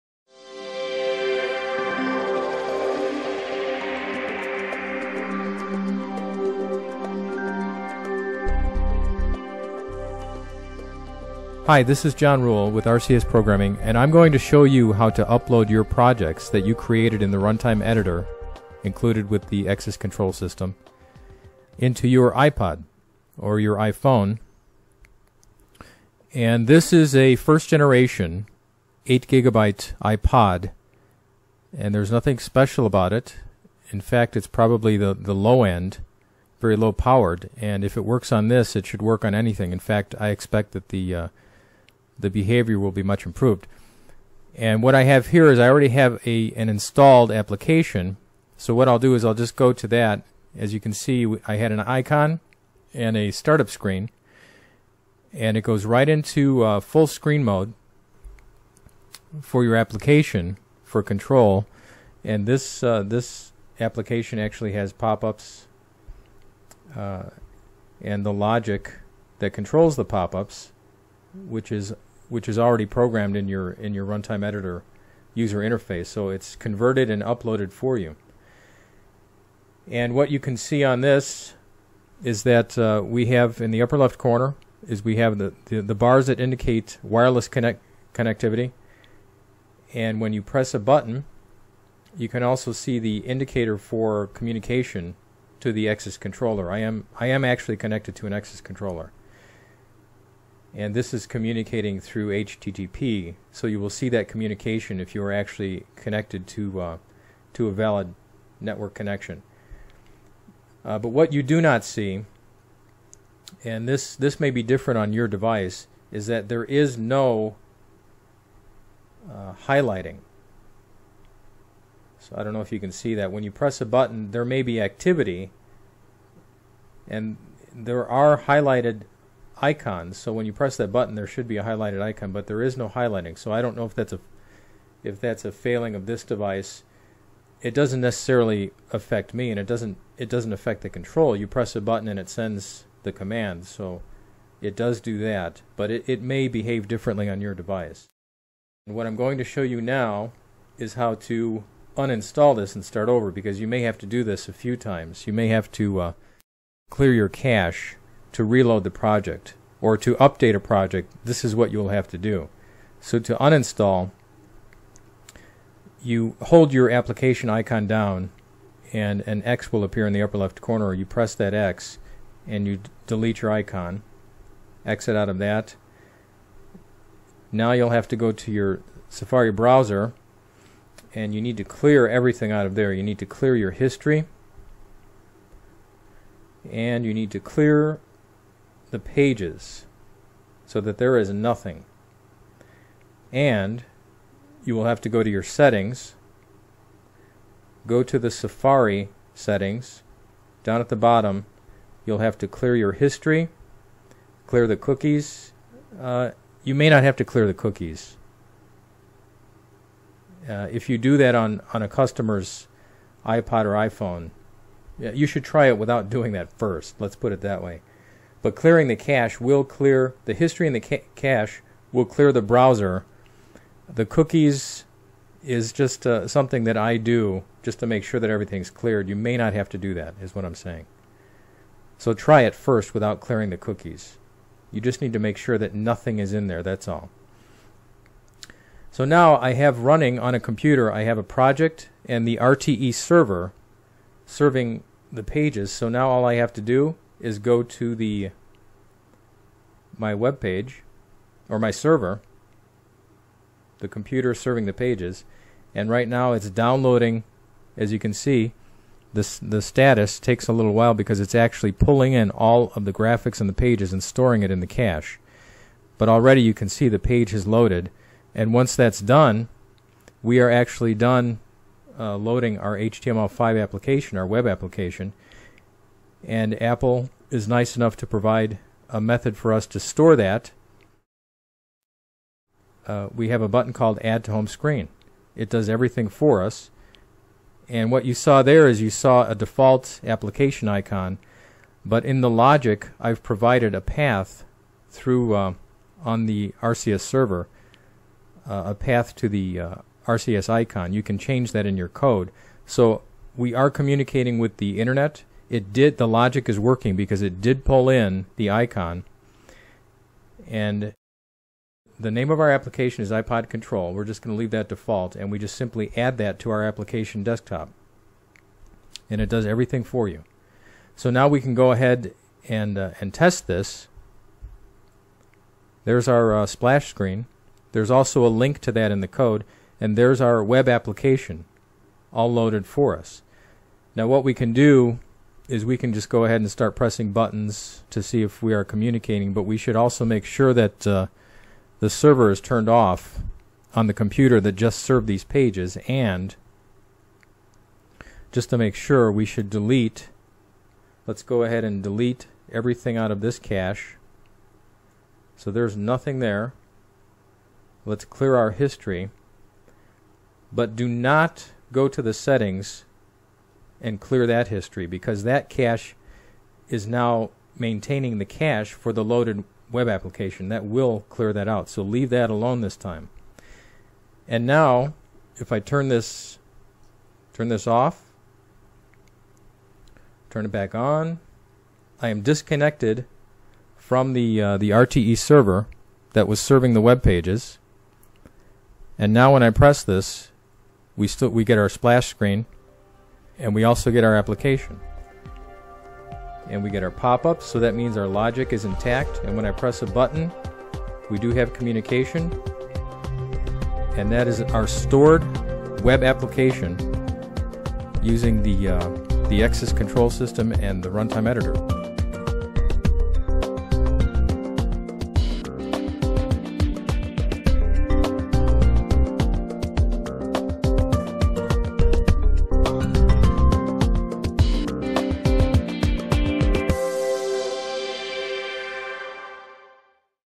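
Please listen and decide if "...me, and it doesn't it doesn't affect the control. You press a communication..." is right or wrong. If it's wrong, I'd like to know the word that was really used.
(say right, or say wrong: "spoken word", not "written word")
wrong: "button", not "communication".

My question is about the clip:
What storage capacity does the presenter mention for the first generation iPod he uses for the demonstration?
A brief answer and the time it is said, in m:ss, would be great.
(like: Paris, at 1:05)
8 gigabytes, at 0:29.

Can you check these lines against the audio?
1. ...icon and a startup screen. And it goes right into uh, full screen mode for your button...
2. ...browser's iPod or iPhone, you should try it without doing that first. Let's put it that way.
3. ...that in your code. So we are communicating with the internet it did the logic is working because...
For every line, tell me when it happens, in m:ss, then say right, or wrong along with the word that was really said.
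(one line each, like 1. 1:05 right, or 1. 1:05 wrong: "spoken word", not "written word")
1. 0:51 wrong: "application", not "button"
2. 3:31 wrong: "customer", not "browser"
3. 5:01 right.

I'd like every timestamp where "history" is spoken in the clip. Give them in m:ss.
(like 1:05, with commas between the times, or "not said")
3:03, 3:22, 3:40, 5:58, 6:04.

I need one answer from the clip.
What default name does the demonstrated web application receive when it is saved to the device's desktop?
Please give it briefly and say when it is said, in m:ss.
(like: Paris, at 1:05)
iPod control, at 5:13.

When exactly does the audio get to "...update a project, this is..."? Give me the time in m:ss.
2:40.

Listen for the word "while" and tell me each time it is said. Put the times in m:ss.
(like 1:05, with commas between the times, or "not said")
4:20.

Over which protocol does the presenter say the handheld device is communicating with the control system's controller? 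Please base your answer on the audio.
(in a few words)
HTTP.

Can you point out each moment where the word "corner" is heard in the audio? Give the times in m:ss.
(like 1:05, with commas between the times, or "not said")
1:24, 2:50.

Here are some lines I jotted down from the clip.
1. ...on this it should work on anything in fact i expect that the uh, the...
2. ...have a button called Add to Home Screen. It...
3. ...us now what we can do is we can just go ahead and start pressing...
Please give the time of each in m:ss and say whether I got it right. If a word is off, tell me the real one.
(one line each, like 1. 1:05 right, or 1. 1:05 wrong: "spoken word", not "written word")
1. 0:38 right
2. 4:43 right
3. 5:32 right.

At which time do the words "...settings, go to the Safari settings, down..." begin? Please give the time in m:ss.
3:15.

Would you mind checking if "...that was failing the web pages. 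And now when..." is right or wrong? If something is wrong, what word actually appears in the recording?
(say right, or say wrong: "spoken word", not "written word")
wrong: "serving", not "failing".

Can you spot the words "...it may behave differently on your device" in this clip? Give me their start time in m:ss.
2:26.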